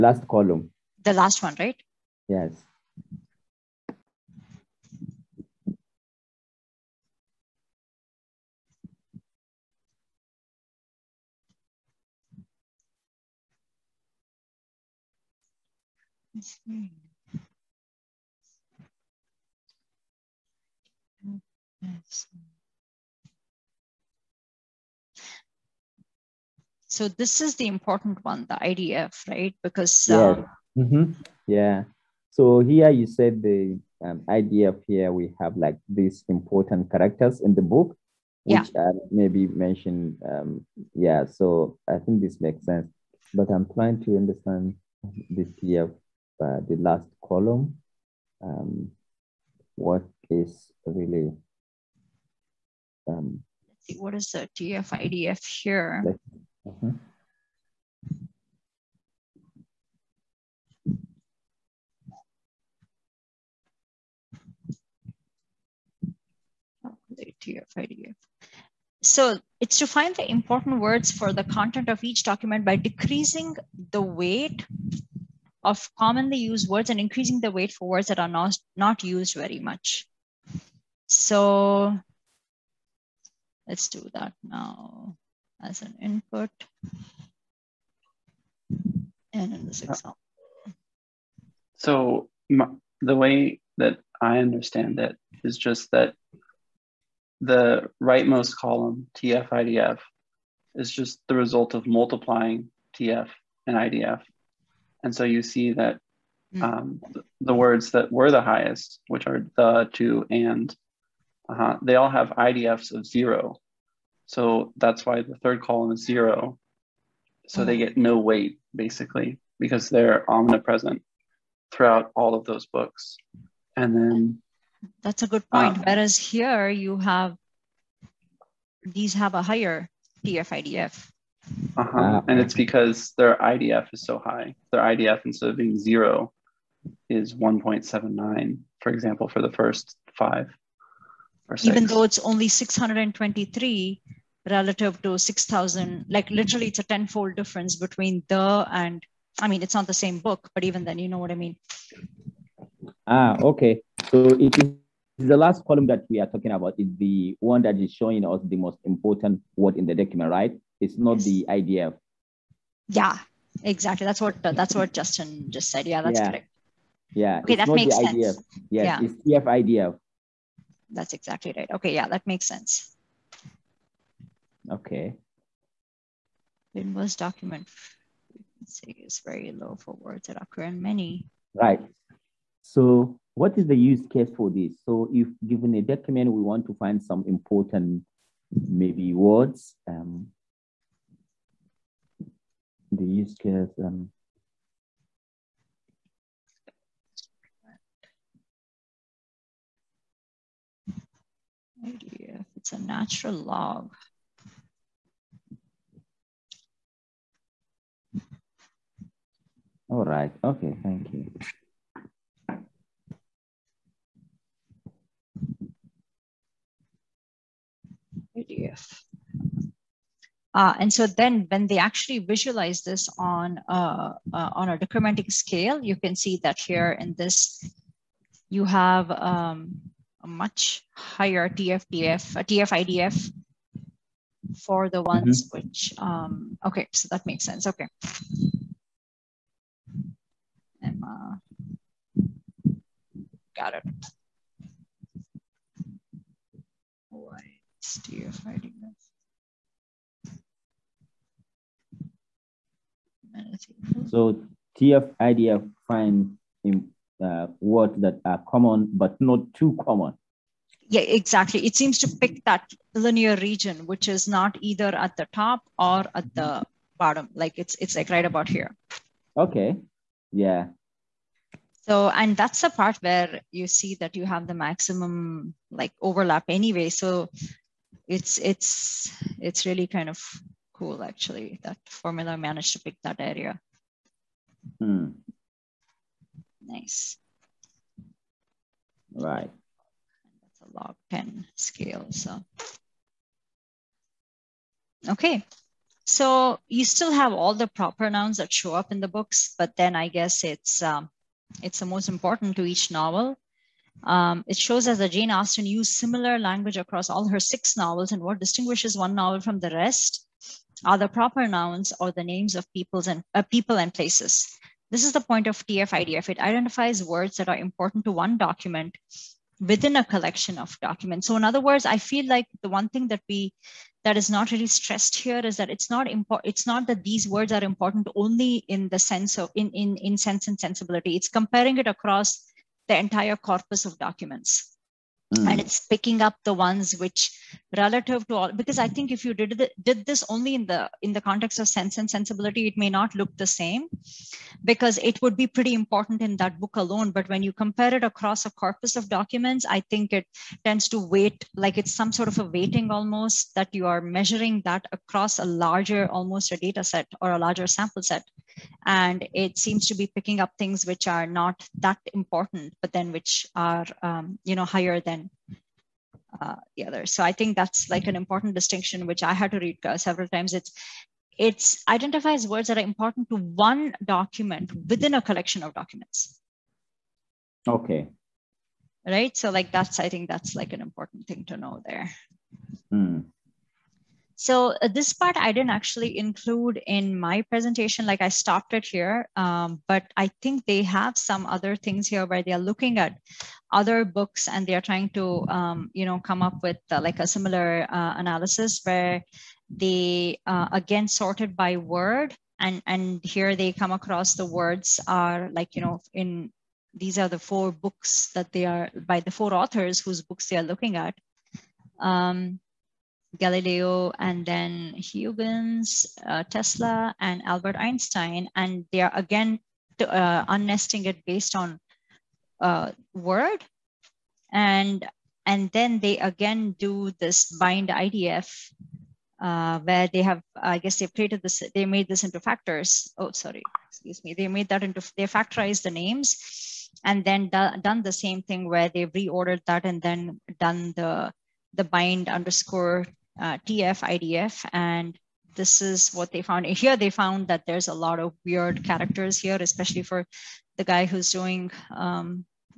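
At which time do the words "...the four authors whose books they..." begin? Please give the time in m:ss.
6:49.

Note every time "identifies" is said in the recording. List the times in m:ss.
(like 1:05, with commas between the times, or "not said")
5:16, 6:11.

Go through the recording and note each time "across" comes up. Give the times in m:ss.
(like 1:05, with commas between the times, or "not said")
5:06, 5:31, 5:48, 5:54, 6:43.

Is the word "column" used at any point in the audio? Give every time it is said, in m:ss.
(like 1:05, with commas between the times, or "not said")
0:00, 0:47, 1:38, 1:55, 2:35.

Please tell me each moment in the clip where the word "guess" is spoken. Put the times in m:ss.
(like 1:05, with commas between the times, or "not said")
5:00, 7:10.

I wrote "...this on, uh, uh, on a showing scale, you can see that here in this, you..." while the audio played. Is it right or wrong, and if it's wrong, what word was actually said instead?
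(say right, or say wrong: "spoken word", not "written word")
wrong: "decrementing", not "showing".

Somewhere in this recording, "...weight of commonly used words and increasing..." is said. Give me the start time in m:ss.
1:14.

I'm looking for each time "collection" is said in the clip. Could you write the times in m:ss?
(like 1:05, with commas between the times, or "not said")
5:20, 6:15.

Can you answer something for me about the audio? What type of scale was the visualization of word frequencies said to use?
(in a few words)
log 10 scale.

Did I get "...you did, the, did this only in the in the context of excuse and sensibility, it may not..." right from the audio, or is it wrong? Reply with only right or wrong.
wrong.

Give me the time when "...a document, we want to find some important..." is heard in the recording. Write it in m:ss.
3:05.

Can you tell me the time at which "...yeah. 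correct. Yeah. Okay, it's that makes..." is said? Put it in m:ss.
2:46.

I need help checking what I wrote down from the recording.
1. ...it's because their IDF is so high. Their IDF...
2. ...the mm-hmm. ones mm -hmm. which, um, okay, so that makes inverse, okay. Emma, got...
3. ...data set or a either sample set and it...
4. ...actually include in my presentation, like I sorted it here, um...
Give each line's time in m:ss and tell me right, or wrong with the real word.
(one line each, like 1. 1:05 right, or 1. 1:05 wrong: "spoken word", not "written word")
1. 2:12 right
2. 3:54 wrong: "sense", not "inverse"
3. 5:56 wrong: "larger", not "either"
4. 6:25 wrong: "stopped", not "sorted".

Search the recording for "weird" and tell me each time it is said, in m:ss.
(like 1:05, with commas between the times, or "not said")
7:28.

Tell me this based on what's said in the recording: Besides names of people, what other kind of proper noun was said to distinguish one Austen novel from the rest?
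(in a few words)
places.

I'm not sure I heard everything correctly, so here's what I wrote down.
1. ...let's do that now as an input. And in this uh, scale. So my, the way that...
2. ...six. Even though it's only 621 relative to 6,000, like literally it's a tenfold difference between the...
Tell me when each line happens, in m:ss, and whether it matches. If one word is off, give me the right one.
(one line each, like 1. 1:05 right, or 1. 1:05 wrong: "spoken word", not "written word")
1. 1:23 wrong: "example", not "scale"
2. 2:21 wrong: "623", not "621".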